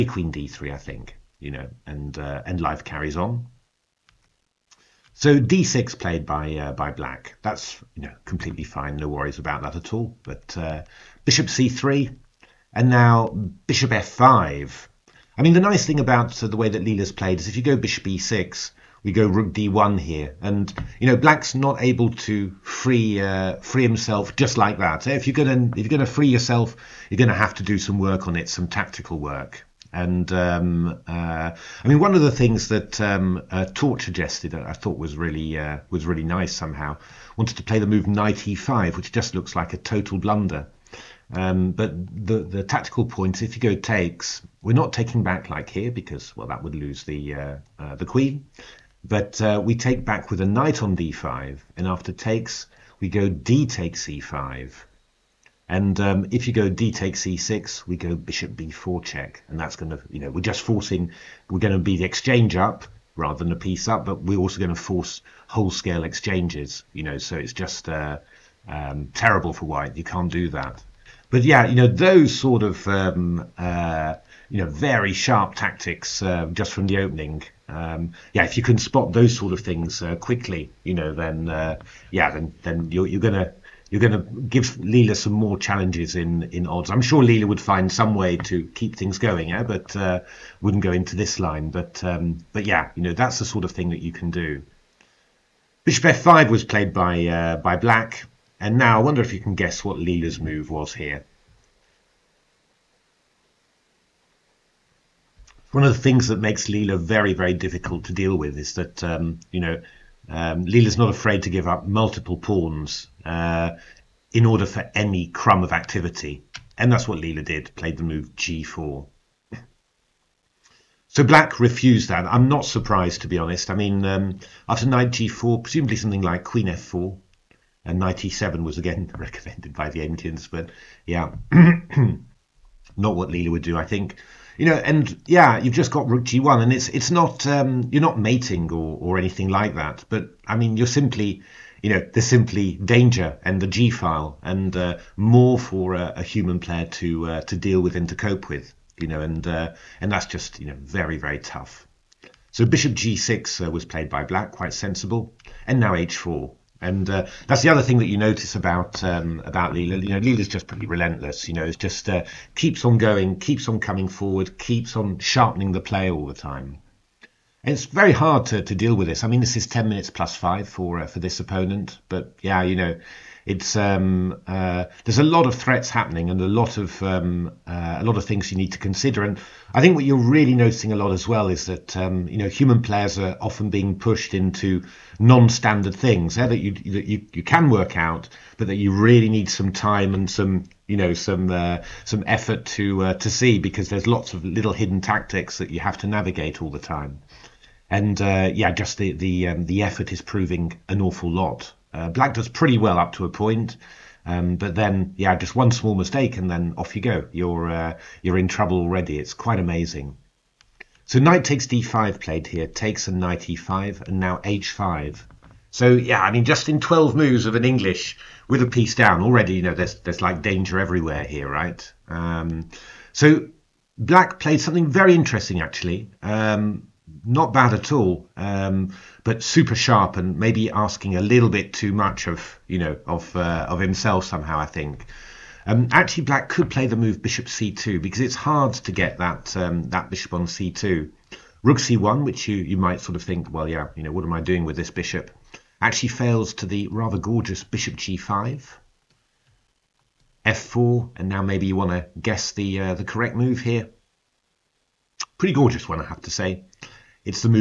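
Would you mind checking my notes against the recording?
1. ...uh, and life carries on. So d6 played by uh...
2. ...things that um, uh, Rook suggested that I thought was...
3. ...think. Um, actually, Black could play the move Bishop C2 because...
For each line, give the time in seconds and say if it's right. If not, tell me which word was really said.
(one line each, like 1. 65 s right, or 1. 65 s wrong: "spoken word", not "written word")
1. 2 s right
2. 32 s wrong: "Tort", not "Rook"
3. 234 s right.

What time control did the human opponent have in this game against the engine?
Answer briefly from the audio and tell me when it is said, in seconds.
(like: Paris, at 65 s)
10 minutes plus 5, at 169 s.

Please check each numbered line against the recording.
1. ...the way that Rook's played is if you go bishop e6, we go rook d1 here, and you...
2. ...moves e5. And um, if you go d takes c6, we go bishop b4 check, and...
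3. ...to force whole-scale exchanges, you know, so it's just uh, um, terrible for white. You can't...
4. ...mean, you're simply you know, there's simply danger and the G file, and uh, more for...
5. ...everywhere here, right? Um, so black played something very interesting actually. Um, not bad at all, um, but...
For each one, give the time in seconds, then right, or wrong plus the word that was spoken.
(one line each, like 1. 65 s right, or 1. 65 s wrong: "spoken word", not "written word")
1. 16 s wrong: "Leela", not "Rook"
2. 53 s wrong: "takes", not "moves"
3. 64 s right
4. 140 s right
5. 220 s right.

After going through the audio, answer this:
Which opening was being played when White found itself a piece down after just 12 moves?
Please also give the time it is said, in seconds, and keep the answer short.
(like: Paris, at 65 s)
English, at 217 s.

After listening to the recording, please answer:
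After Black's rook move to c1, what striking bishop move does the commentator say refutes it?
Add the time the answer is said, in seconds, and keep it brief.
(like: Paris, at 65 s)
Bishop g5, at 247 s.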